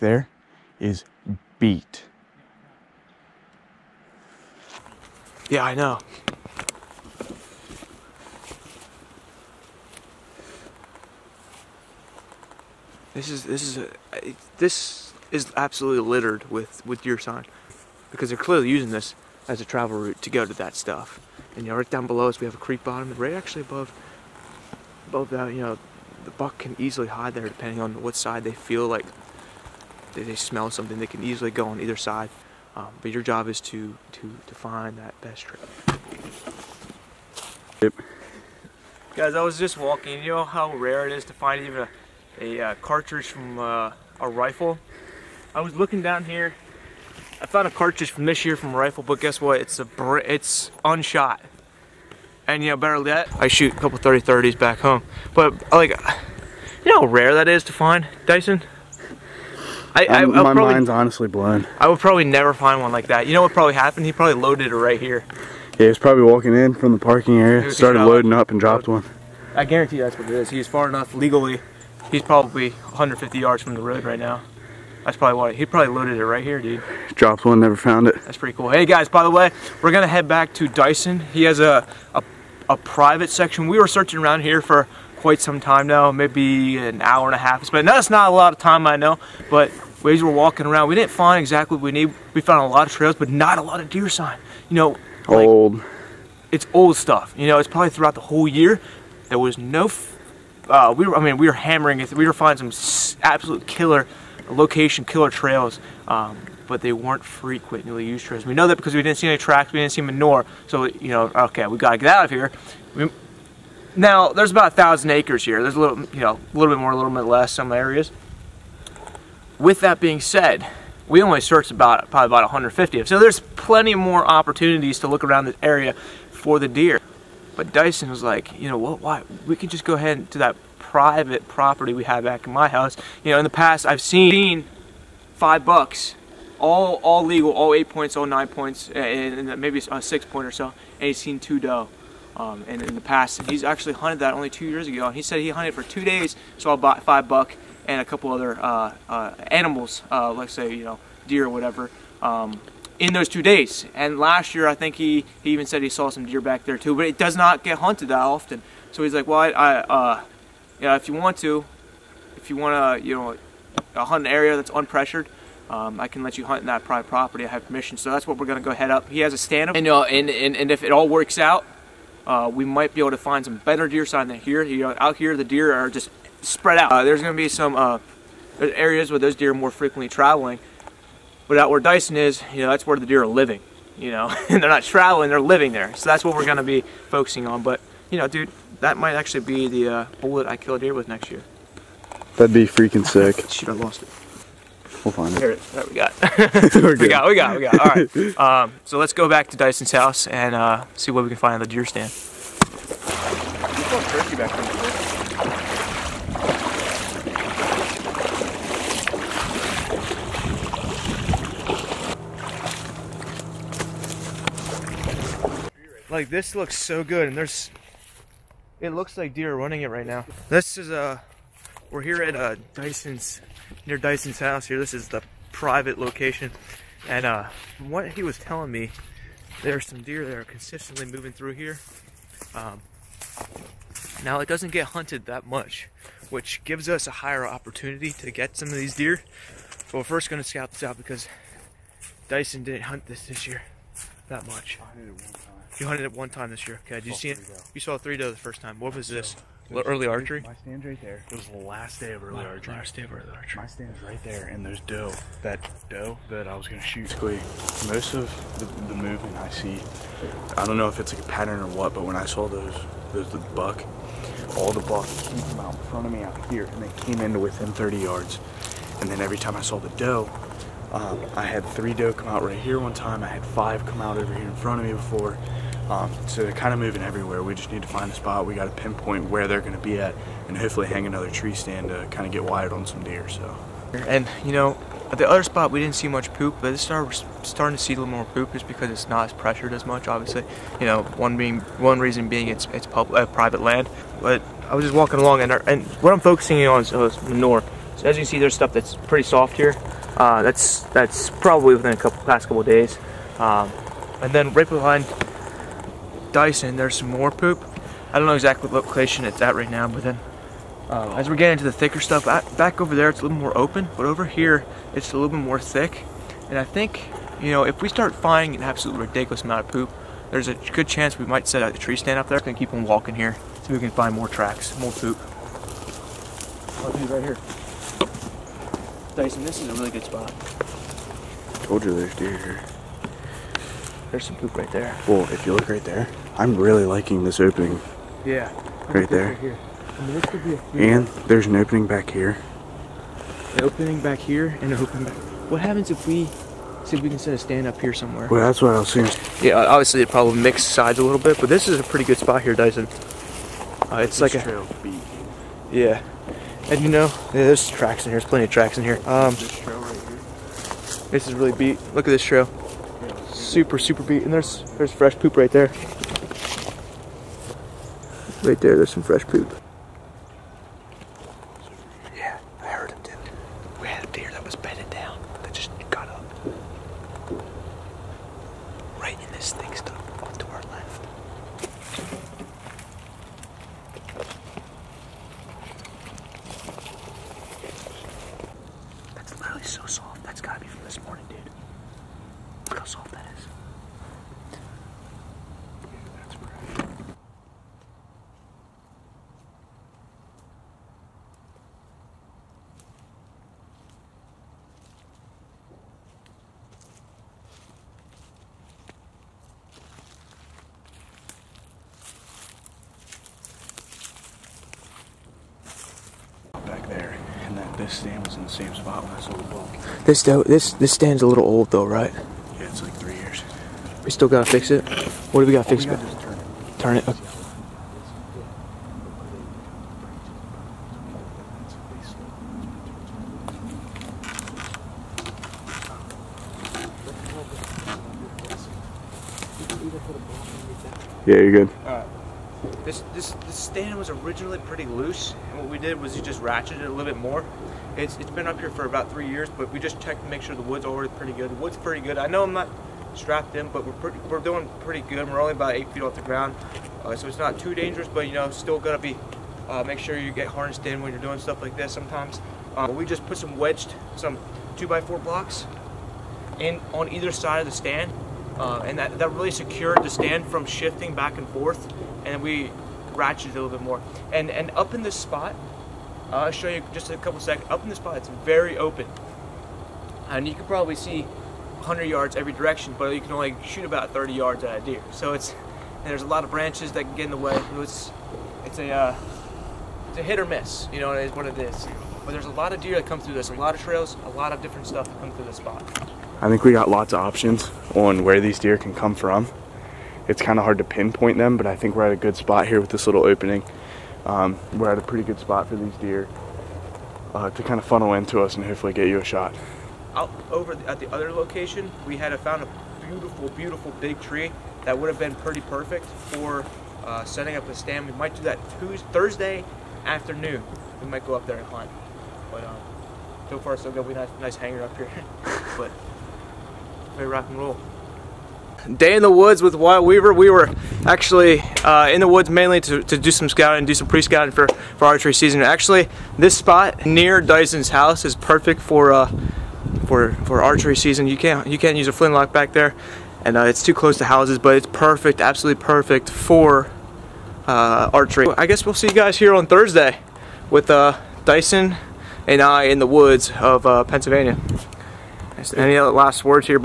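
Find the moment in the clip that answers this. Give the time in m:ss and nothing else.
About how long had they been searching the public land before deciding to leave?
1:26.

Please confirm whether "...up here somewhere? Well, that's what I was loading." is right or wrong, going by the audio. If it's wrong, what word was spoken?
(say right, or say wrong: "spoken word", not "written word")
wrong: "seeing", not "loading".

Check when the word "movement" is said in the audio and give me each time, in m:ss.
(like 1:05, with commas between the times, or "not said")
4:18.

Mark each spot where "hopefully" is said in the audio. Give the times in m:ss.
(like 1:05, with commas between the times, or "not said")
4:40, 8:28.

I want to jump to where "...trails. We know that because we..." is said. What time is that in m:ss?
1:48.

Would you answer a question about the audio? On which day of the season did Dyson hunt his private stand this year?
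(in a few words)
last day of early archery.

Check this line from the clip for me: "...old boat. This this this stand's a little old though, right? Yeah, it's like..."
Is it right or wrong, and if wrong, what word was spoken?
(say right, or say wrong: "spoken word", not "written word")
right.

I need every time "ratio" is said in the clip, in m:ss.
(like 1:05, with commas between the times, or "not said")
not said.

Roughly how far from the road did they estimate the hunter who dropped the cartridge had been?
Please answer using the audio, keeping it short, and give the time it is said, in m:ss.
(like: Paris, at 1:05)
150 yards, at 1:12.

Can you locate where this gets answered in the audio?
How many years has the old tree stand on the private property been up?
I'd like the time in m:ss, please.
7:28.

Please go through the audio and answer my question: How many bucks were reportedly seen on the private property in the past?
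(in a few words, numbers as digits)
5.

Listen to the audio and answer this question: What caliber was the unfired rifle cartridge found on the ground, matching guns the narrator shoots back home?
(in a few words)
30-30.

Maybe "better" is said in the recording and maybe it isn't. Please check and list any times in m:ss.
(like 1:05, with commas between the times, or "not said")
0:52, 2:53.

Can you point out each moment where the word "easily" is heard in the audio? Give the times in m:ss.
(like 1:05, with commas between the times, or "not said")
0:26, 0:31.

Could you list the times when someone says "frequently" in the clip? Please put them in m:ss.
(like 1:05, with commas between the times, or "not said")
1:47, 2:59.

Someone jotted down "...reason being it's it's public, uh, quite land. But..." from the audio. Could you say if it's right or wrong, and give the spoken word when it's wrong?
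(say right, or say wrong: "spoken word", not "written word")
wrong: "private", not "quite".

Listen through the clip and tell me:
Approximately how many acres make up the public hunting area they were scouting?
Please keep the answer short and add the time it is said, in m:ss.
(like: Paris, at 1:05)
1000, at 1:54.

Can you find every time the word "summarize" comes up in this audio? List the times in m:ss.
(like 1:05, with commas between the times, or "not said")
not said.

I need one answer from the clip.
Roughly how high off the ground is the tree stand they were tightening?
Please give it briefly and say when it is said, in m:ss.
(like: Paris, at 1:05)
8 feet, at 7:35.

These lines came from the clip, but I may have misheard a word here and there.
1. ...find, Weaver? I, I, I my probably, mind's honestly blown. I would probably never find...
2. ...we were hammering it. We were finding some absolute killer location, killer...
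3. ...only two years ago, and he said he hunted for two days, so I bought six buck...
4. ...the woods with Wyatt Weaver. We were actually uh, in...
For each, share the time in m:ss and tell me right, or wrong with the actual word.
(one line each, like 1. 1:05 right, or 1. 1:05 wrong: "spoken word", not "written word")
1. 0:57 wrong: "Dyson", not "Weaver"
2. 1:41 right
3. 2:24 wrong: "five", not "six"
4. 8:49 right.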